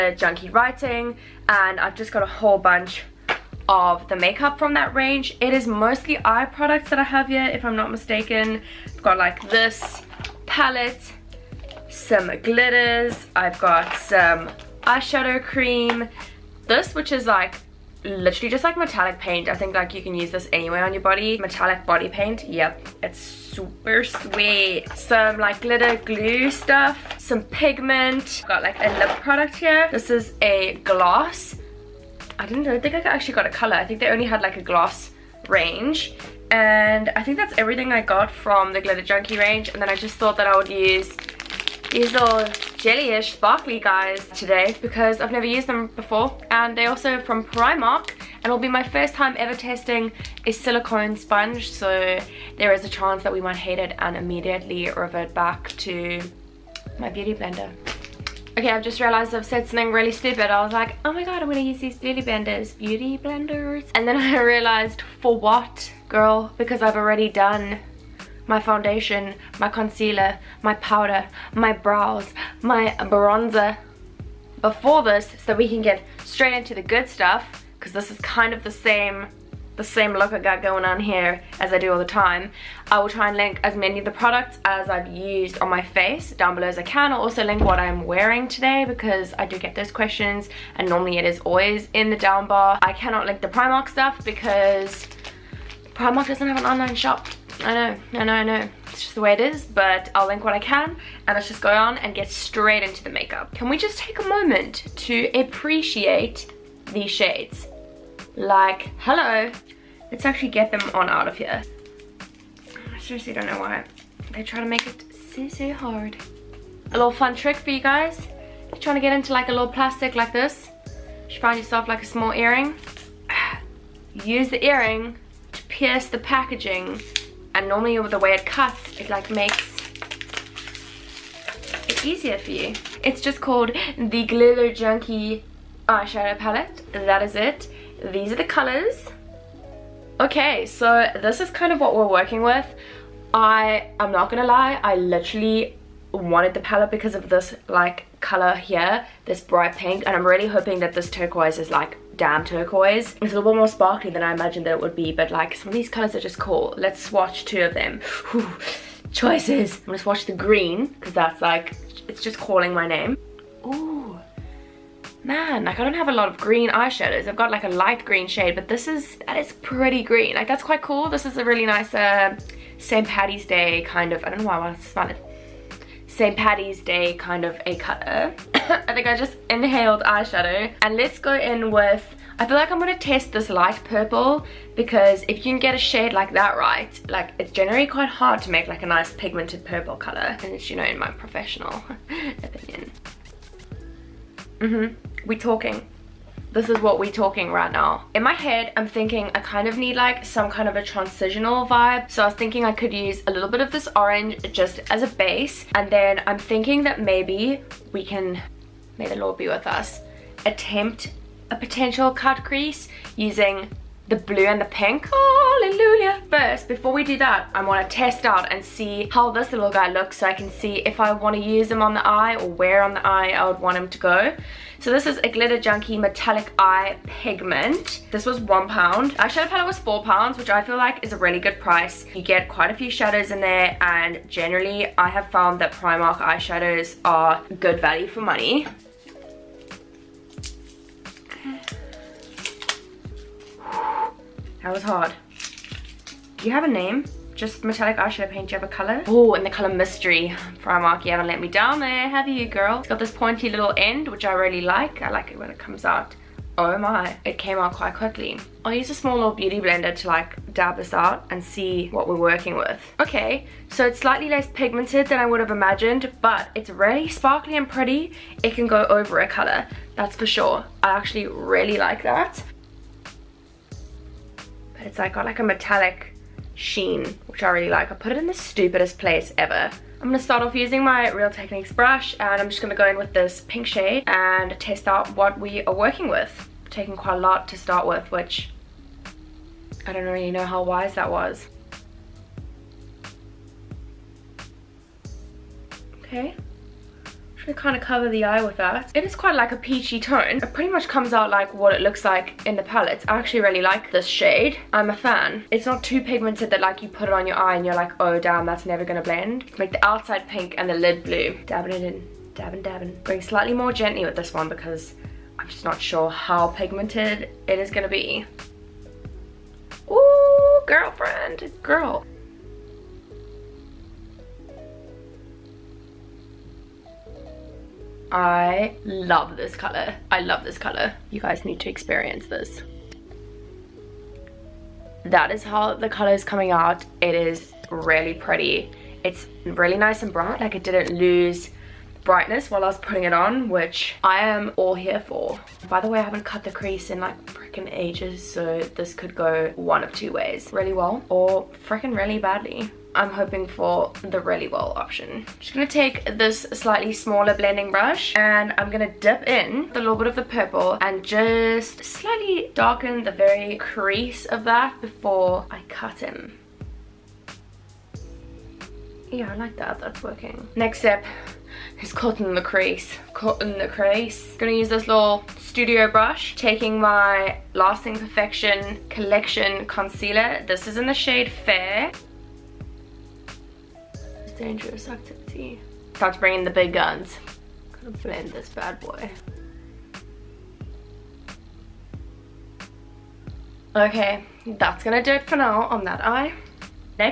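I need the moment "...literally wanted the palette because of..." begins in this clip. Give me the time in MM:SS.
02:24.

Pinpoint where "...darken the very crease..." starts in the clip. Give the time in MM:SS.
06:02.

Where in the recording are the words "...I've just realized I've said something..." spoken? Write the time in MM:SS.
00:58.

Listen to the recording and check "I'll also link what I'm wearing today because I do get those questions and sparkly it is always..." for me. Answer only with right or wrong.
wrong.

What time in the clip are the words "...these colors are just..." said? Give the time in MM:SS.
02:35.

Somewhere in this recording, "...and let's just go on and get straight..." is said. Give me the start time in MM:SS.
01:41.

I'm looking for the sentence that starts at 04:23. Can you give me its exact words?
Okay, so it's slightly less pigmented than I would have imagined, but it's really sparkly and pretty.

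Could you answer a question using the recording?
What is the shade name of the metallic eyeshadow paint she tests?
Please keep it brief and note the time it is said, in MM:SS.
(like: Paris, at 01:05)
Mystery, at 04:09.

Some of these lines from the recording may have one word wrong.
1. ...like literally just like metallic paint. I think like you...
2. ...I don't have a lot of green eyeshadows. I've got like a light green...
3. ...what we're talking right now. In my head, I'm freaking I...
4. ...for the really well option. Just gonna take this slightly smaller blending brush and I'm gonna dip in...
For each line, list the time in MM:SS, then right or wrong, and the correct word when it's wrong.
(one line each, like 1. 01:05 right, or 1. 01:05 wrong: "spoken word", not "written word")
1. 00:17 right
2. 02:45 right
3. 03:16 wrong: "thinking", not "freaking"
4. 05:53 right.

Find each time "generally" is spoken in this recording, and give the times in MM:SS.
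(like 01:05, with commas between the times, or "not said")
03:07, 03:54.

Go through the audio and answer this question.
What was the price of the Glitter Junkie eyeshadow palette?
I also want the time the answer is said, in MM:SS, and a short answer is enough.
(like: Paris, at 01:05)
4 pounds, at 03:49.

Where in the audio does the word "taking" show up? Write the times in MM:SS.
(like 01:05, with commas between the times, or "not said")
04:46, 06:16.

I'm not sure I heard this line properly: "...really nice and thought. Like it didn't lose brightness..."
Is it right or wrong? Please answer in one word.
wrong.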